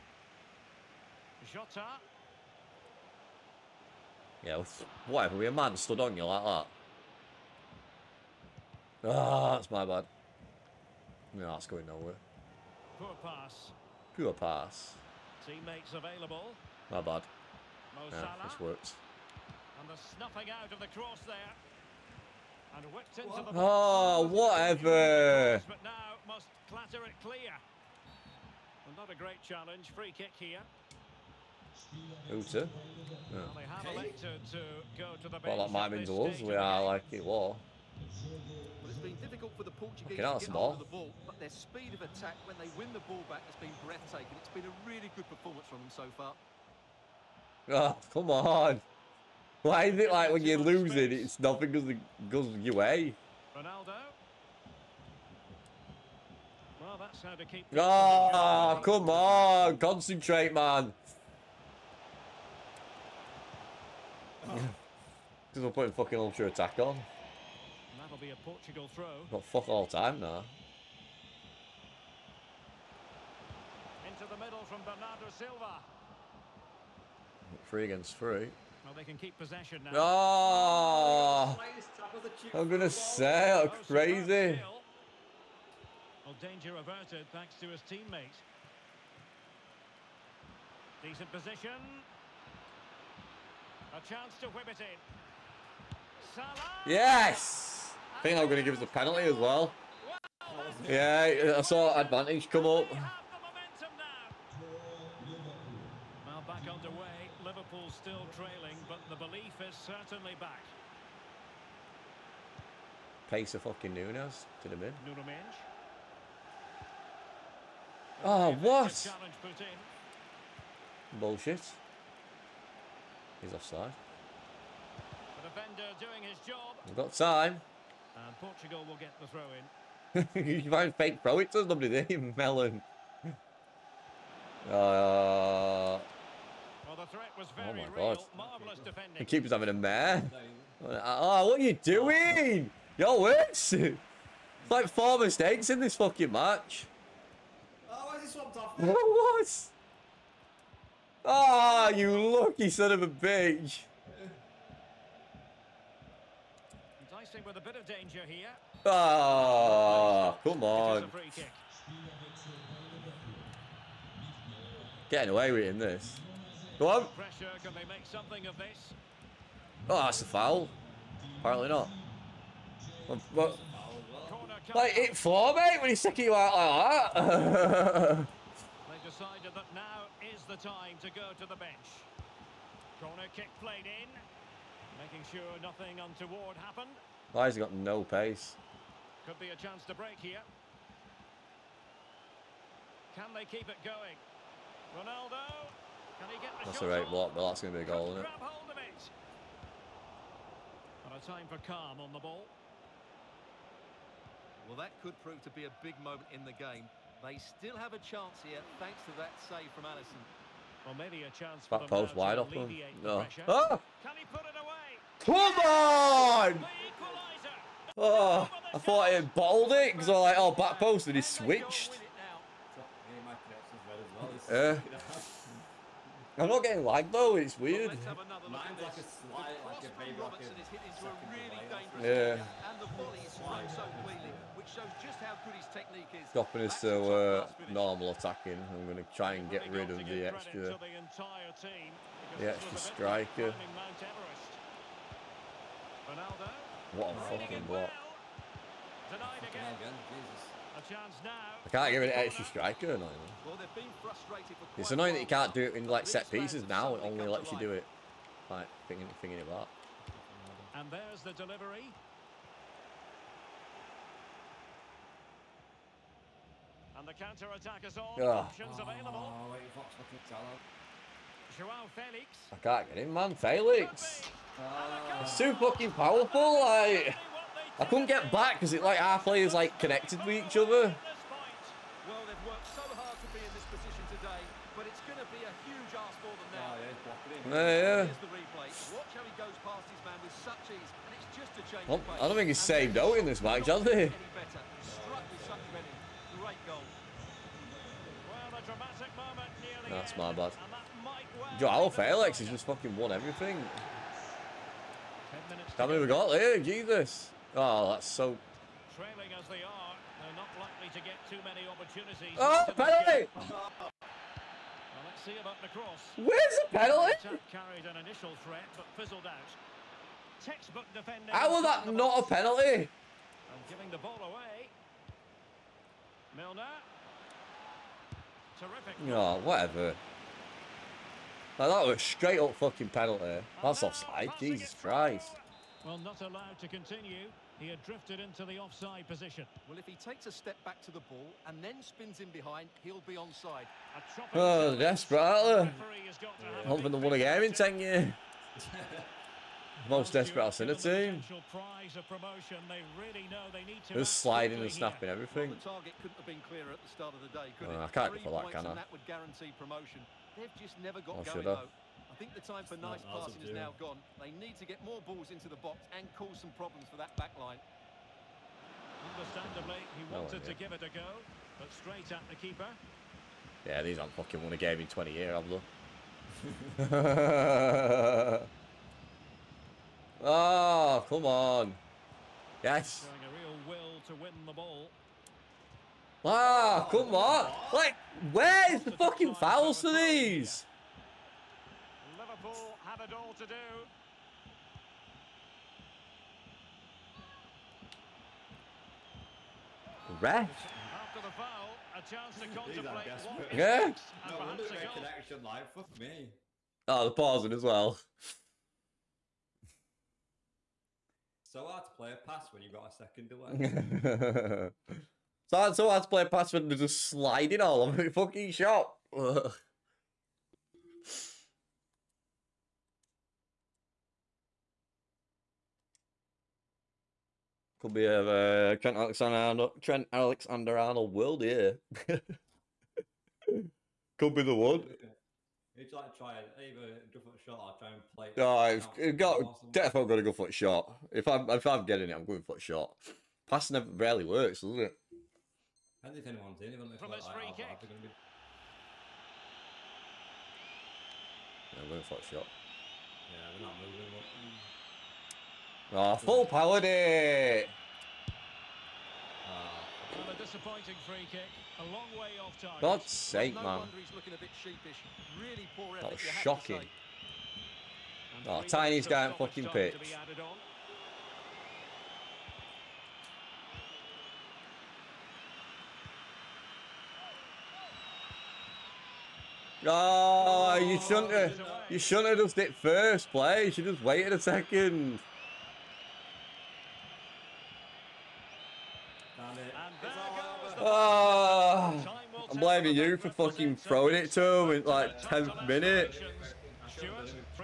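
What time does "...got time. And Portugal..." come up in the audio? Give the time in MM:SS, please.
02:06.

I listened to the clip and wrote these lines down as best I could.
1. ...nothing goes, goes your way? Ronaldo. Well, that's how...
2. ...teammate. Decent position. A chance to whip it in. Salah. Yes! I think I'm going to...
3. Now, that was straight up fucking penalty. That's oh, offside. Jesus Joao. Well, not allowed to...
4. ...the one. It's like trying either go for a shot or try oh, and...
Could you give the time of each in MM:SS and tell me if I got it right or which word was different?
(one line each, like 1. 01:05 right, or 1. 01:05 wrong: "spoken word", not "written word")
1. 00:51 right
2. 01:27 right
3. 05:31 wrong: "Christ", not "Joao"
4. 07:14 right.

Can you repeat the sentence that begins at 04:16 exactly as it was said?
It only lets you do it like thinking, thinking about.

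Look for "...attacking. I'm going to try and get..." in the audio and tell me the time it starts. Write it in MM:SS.
03:58.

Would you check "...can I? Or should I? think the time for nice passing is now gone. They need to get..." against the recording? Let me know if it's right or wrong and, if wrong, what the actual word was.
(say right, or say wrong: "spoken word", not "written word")
right.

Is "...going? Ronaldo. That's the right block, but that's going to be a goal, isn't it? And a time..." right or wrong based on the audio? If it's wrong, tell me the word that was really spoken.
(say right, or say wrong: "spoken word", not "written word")
right.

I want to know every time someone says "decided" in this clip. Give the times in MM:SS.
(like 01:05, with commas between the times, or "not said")
02:59.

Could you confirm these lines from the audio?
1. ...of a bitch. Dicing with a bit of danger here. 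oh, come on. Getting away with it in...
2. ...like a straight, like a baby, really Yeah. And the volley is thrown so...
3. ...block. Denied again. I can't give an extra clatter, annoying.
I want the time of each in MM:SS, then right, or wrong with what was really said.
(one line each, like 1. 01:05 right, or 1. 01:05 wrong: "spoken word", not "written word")
1. 02:32 right
2. 03:48 wrong: "slight", not "straight"
3. 04:07 wrong: "striker", not "clatter".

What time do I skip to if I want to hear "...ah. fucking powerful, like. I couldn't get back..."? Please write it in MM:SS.
04:35.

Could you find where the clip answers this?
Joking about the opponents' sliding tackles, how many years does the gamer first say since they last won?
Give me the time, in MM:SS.
05:47.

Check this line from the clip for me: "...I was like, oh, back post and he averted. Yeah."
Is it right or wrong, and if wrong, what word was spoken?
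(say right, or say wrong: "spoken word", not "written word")
wrong: "switched", not "averted".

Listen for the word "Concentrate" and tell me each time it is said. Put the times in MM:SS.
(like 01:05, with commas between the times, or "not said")
00:59.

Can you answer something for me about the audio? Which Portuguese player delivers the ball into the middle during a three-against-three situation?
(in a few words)
Bernardo Silva.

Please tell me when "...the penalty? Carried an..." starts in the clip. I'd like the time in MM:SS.
05:16.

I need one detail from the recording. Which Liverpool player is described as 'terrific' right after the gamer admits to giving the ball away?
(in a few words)
Milner.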